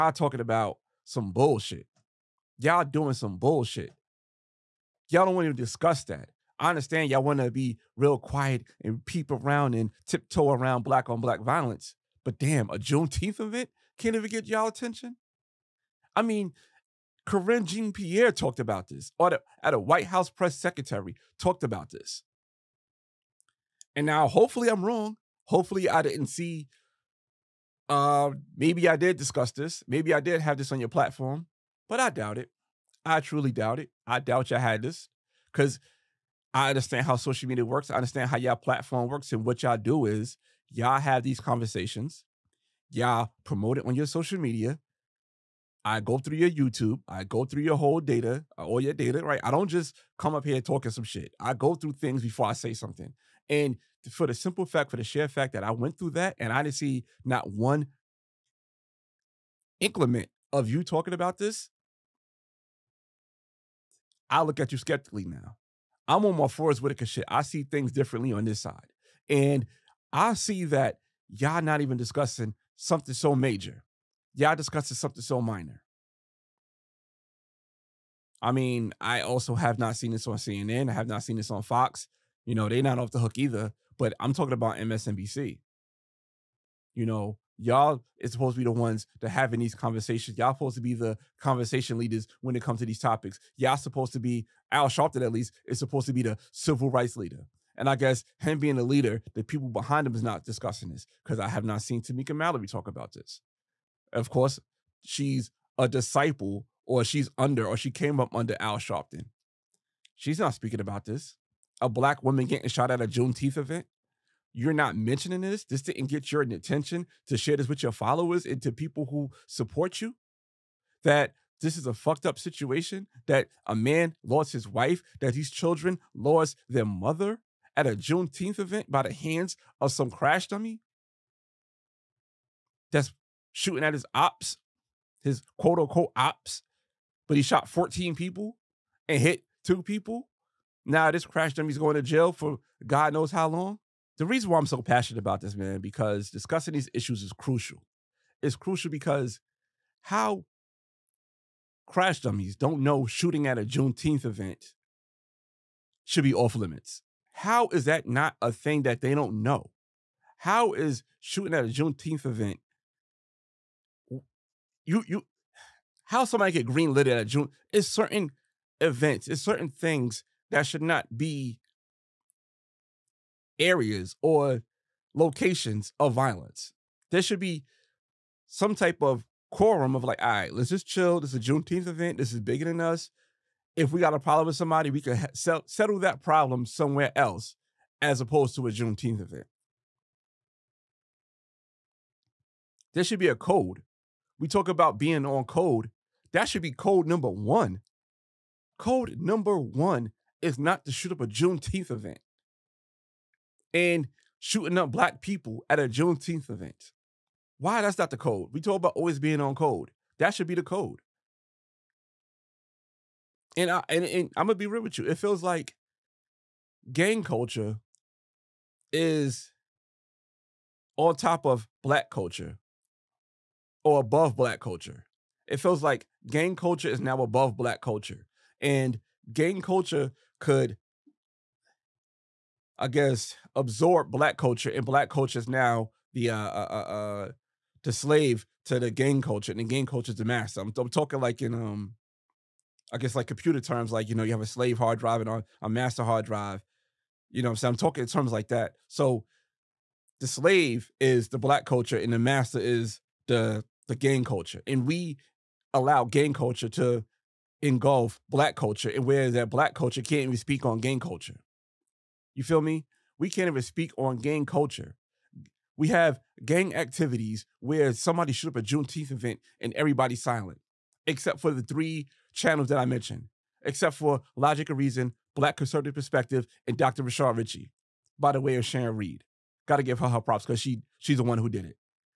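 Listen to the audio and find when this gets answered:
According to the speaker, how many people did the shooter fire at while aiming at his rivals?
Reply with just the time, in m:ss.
2:17.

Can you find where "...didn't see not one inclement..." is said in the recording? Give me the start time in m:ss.
0:56.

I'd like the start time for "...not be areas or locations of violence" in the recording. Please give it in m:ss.
2:50.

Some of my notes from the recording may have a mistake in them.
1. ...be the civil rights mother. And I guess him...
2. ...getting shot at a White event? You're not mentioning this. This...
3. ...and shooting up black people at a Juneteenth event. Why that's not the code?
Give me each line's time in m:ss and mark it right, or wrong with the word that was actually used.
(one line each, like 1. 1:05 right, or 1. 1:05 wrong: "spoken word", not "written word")
1. 1:36 wrong: "leader", not "mother"
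2. 1:52 wrong: "Juneteenth", not "White"
3. 3:23 right.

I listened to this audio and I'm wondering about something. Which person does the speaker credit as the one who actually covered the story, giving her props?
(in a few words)
Sharon Reed.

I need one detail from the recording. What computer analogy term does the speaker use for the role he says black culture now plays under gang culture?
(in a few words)
slave hard drive.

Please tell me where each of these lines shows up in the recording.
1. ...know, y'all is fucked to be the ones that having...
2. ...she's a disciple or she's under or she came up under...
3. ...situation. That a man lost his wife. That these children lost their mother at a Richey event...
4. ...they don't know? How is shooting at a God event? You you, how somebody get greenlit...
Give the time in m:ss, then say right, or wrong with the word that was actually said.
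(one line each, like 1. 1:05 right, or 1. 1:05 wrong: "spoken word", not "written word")
1. 1:27 wrong: "supposed", not "fucked"
2. 1:45 right
3. 2:02 wrong: "Juneteenth", not "Richey"
4. 2:39 wrong: "Juneteenth", not "God".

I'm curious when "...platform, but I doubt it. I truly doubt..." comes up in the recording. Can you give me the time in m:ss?
0:30.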